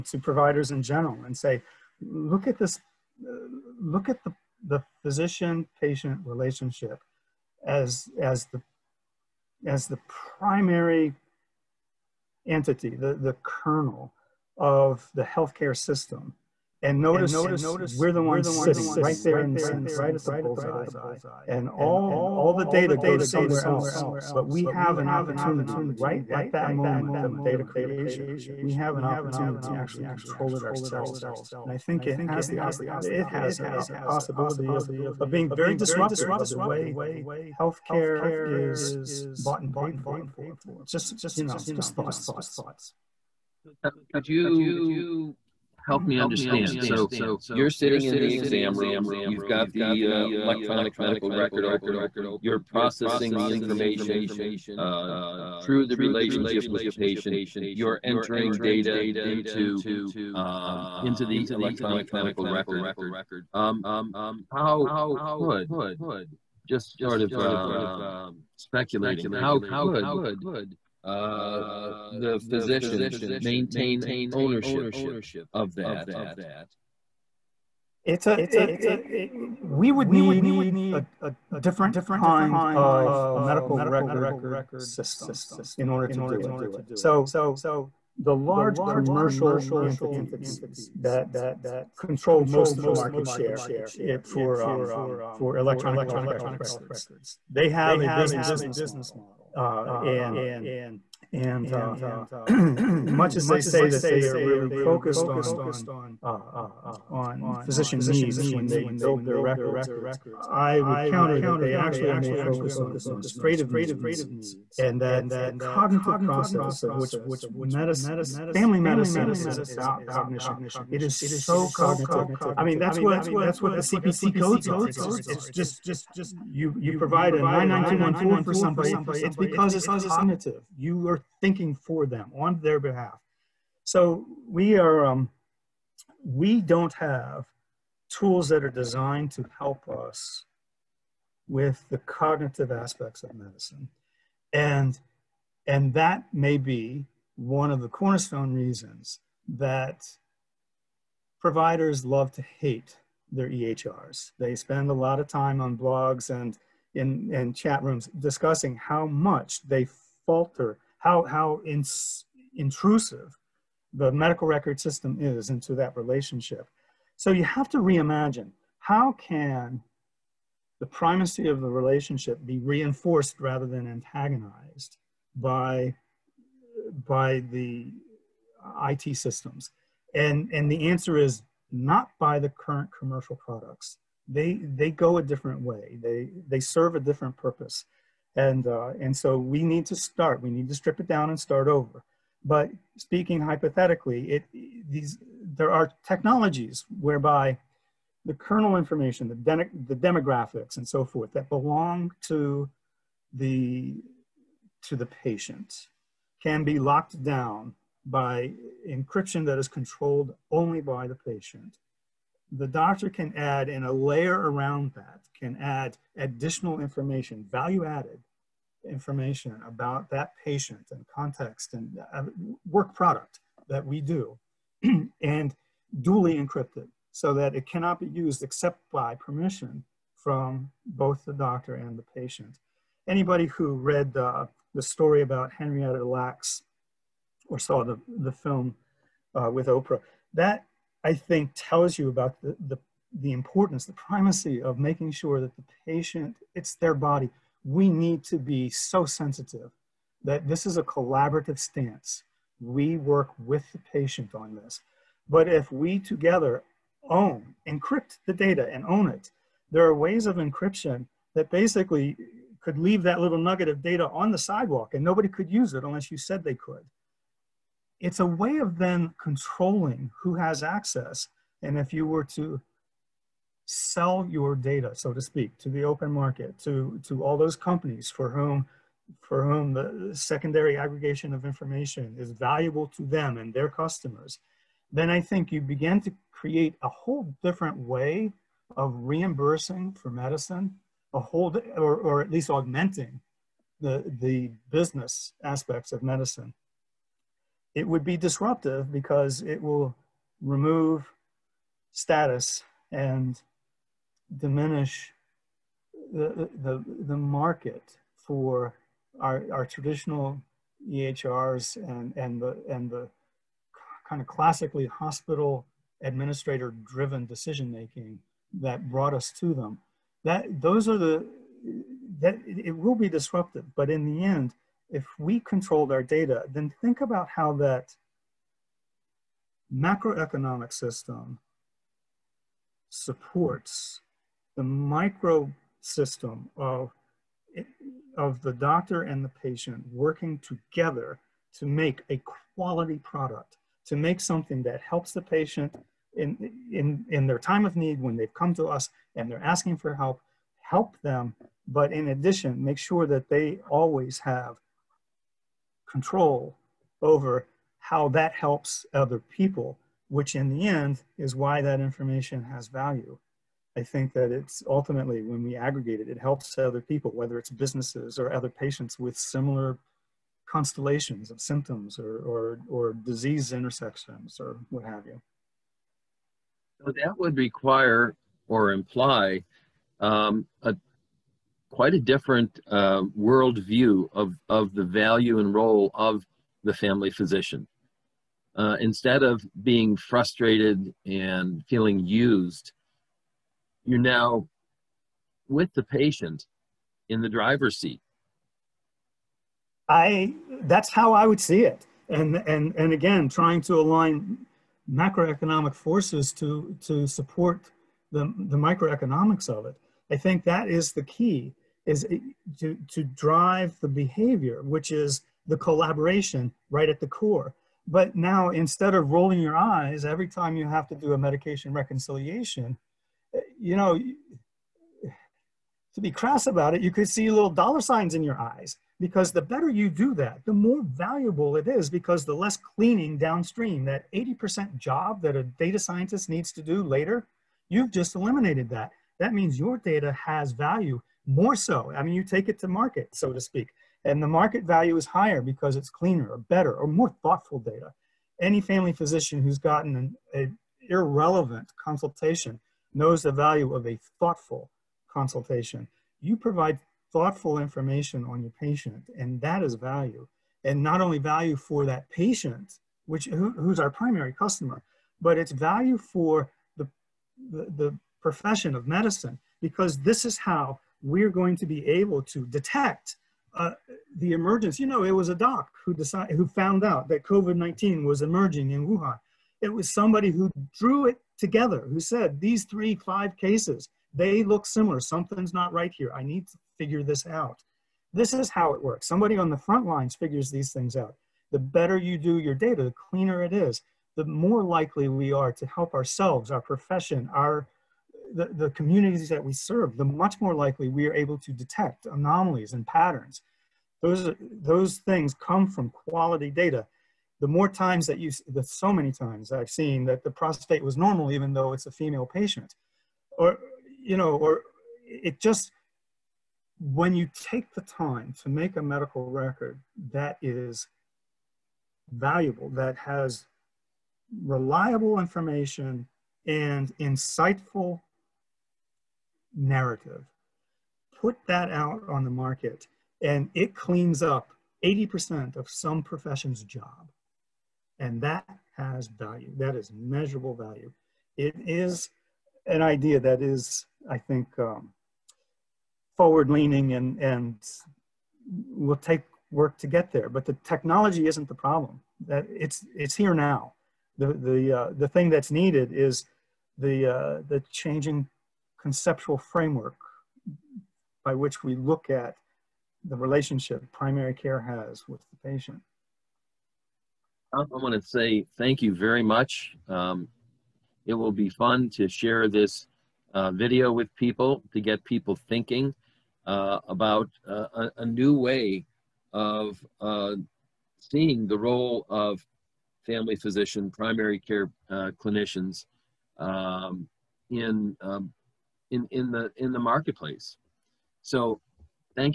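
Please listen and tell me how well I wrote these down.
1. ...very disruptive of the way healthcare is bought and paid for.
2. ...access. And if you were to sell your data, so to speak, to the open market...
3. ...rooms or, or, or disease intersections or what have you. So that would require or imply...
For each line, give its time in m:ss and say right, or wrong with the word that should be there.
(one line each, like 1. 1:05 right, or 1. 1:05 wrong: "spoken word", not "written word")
1. 0:35 right
2. 4:30 right
3. 6:11 wrong: "symptoms", not "rooms".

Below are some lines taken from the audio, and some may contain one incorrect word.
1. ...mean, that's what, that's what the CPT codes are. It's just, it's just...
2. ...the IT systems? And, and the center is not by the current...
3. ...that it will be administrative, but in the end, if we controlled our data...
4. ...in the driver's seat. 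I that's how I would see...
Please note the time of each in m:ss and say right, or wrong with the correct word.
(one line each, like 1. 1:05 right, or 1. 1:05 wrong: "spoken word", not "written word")
1. 2:02 right
2. 2:57 wrong: "answer", not "center"
3. 5:22 wrong: "disruptive", not "administrative"
4. 6:37 right.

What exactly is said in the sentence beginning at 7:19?
That means your data has value more so.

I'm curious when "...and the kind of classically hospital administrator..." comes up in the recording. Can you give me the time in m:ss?
5:12.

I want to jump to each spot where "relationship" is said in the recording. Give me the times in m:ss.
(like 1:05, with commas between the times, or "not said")
0:06, 0:55, 2:45, 2:51, 9:23.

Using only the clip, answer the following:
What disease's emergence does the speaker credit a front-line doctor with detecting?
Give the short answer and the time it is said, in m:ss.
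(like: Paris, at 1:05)
COVID-19, at 7:57.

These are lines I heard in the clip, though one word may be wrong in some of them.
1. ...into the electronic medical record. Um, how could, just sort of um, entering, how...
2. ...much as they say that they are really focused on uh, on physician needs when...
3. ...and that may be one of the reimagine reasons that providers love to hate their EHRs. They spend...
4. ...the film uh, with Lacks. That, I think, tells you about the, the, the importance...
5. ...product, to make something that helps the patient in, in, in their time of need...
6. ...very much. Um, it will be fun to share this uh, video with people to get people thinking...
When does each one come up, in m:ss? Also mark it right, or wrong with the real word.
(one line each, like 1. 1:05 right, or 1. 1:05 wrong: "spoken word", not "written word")
1. 1:01 wrong: "speculating", not "entering"
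2. 1:43 right
3. 2:25 wrong: "cornerstone", not "reimagine"
4. 3:58 wrong: "Oprah", not "Lacks"
5. 5:42 right
6. 9:28 right.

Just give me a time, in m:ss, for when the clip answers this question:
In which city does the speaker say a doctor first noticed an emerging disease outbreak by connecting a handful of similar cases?
7:58.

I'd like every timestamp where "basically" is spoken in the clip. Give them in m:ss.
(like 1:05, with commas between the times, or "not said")
4:21.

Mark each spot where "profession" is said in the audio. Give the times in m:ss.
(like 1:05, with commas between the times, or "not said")
7:48, 8:16, 8:56.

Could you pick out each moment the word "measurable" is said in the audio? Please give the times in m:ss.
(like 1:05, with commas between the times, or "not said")
8:59.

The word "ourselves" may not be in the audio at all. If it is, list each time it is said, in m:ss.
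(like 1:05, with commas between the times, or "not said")
0:30, 8:15.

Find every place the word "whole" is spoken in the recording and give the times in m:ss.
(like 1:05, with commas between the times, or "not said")
4:46, 4:51.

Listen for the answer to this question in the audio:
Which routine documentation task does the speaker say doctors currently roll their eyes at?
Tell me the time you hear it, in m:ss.
7:01.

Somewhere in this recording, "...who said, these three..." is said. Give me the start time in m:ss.
8:01.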